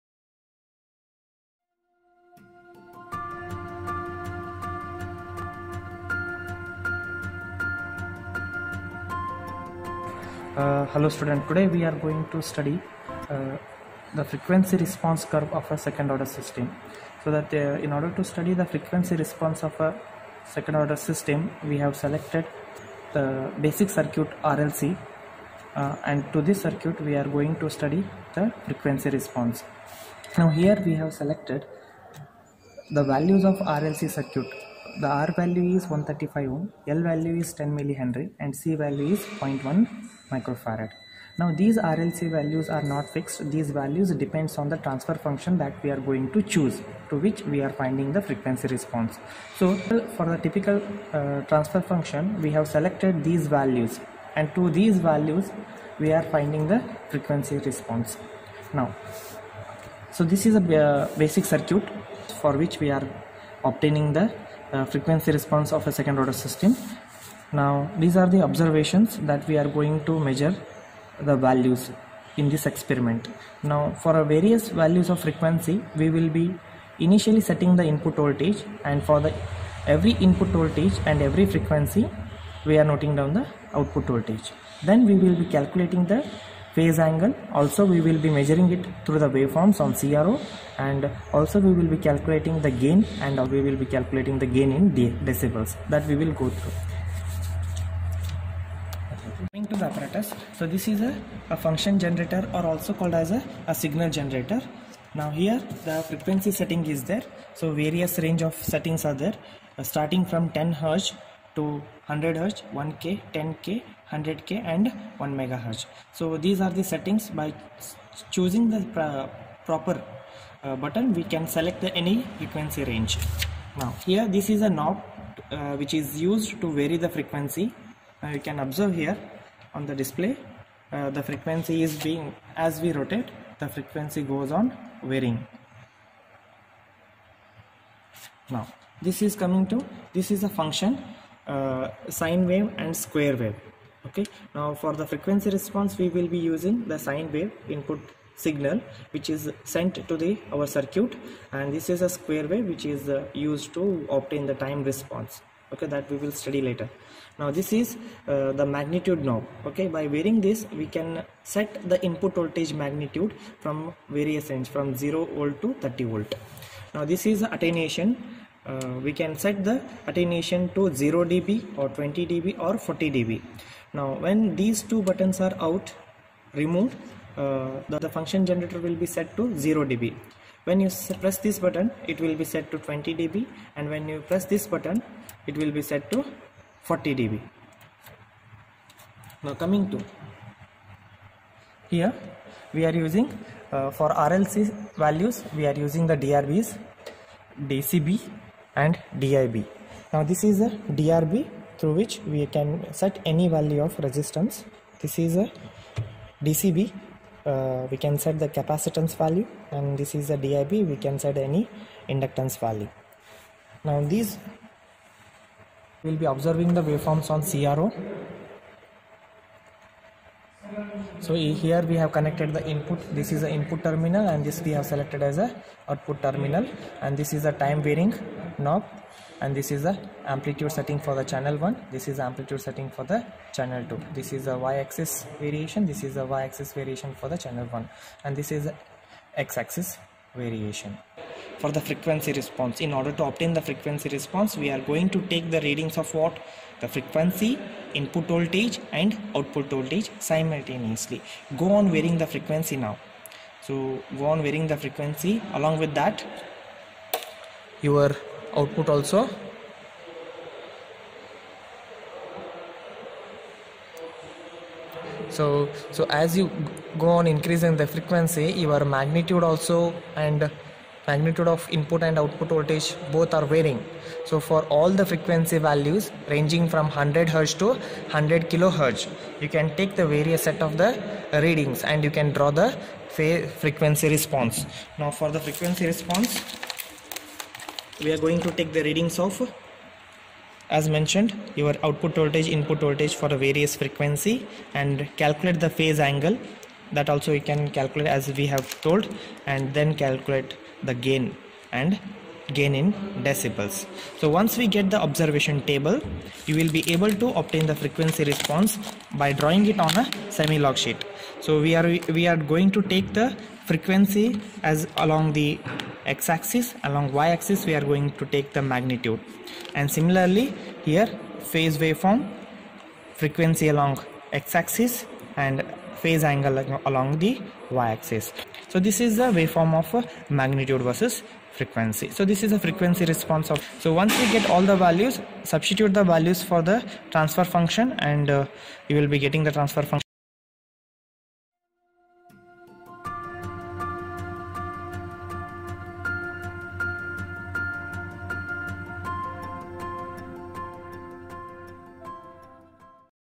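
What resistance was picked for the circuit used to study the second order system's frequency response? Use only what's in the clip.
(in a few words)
135 ohm.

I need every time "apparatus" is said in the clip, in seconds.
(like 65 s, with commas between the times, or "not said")
99 s.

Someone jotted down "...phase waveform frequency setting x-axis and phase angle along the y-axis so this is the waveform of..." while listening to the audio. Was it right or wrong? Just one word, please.
wrong.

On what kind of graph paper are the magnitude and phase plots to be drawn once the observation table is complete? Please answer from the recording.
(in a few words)
semi log sheet.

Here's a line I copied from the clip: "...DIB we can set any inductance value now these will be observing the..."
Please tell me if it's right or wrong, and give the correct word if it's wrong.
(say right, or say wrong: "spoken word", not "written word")
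right.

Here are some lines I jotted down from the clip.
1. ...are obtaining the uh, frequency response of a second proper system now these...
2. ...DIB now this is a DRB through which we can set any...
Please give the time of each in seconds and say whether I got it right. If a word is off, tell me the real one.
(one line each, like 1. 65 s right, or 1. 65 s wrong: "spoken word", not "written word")
1. 62 s wrong: "order", not "proper"
2. 199 s right.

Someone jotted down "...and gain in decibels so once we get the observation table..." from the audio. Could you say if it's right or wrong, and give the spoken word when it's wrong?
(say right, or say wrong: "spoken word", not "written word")
right.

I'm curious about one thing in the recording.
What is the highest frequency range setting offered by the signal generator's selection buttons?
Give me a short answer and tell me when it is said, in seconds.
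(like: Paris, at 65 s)
1 megahertz, at 115 s.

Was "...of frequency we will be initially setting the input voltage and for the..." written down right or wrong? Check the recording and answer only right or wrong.
right.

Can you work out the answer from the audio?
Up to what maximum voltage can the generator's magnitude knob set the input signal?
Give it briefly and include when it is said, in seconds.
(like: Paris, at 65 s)
30 volt, at 165 s.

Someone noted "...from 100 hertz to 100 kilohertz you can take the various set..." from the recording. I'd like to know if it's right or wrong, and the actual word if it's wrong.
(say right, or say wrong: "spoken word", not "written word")
right.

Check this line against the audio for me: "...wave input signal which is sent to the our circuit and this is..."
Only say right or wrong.
right.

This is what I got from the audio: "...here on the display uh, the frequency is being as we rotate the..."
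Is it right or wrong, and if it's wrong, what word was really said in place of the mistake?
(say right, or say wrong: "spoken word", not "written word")
right.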